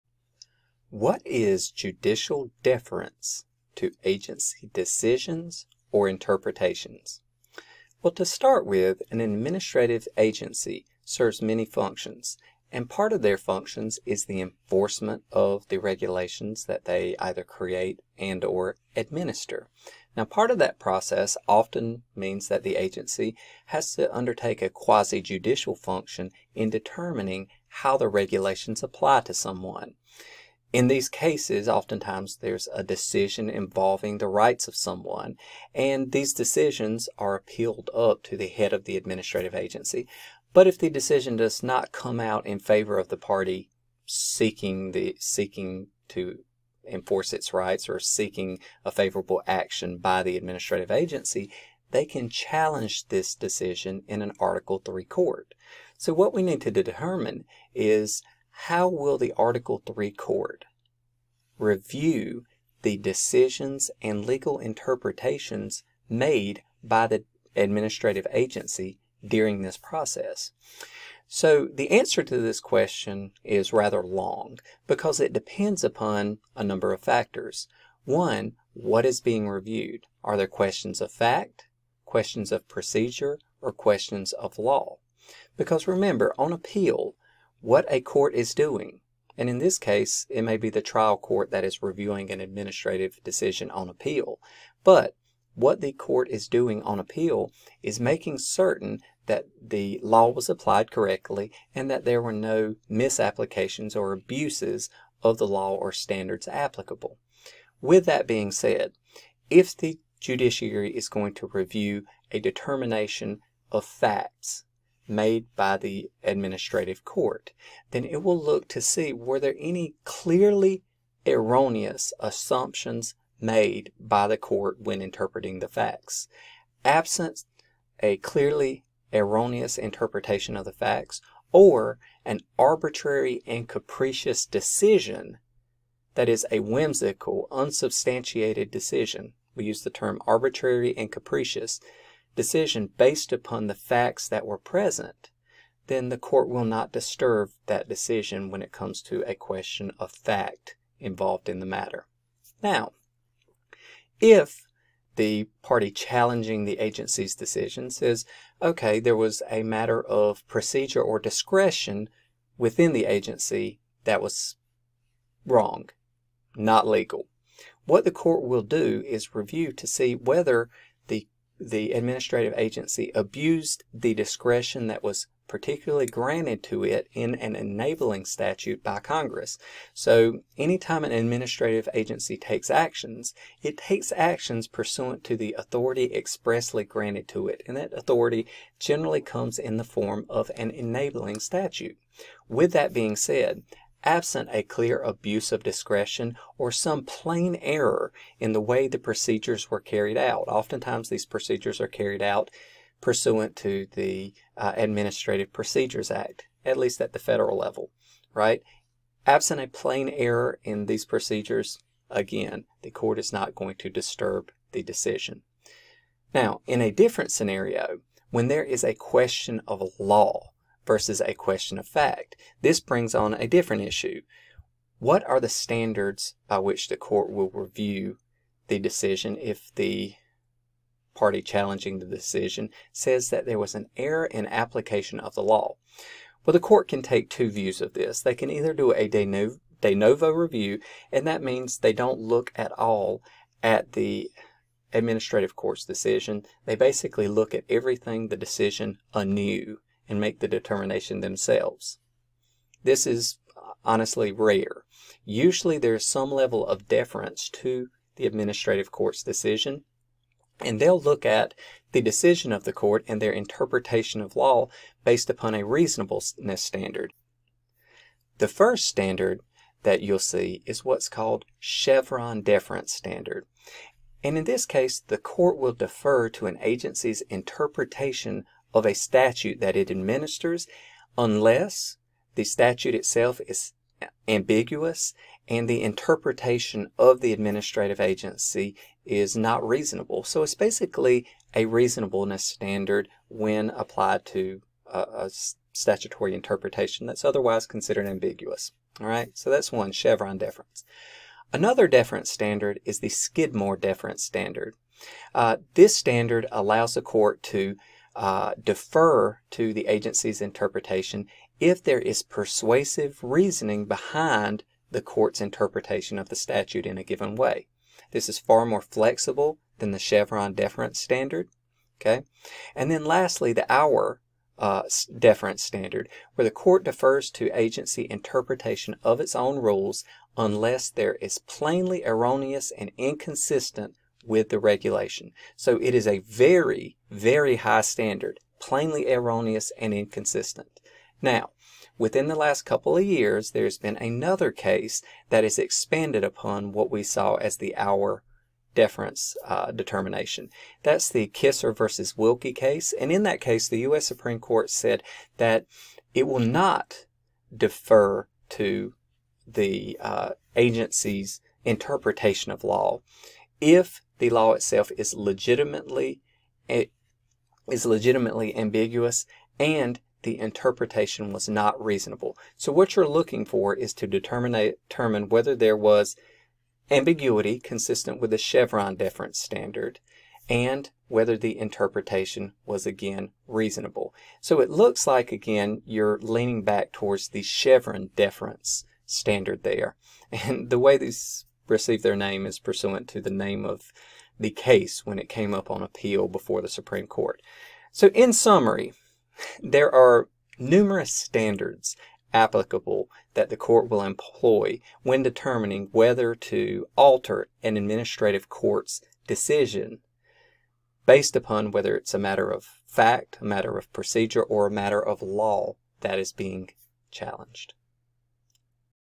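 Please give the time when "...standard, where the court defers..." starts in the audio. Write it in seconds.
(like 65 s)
325 s.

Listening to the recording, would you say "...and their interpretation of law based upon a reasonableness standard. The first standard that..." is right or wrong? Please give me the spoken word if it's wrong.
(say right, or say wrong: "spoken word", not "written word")
right.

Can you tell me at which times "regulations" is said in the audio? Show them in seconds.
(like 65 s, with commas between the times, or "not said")
15 s, 28 s, 334 s.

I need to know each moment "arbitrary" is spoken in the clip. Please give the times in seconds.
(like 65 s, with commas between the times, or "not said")
132 s, 140 s.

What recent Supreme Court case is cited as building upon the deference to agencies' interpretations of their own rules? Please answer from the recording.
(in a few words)
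Kisor versus Wilkie.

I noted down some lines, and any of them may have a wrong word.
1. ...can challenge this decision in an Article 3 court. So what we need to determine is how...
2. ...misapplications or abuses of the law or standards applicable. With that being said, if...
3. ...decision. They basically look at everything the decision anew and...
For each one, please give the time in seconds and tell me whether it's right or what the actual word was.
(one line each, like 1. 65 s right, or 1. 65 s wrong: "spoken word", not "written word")
1. 52 s right
2. 102 s right
3. 245 s right.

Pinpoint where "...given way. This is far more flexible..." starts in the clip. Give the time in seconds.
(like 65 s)
317 s.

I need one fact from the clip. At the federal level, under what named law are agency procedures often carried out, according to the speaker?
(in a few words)
Administrative Procedures Act.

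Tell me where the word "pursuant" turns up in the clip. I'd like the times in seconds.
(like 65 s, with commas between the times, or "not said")
184 s, 202 s, 392 s.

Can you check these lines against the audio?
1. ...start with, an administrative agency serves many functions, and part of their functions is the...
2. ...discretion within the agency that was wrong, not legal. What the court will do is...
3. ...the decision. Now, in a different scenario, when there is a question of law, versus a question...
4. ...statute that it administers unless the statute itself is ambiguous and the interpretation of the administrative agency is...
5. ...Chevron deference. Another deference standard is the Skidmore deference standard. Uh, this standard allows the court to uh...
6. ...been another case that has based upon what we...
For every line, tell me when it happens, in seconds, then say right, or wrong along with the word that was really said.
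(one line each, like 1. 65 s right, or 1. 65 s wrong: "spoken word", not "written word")
1. 8 s right
2. 161 s right
3. 214 s right
4. 278 s right
5. 299 s right
6. 343 s wrong: "expanded", not "based".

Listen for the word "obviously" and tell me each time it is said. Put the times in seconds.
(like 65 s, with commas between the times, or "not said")
not said.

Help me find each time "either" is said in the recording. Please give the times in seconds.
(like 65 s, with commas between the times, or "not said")
17 s, 238 s.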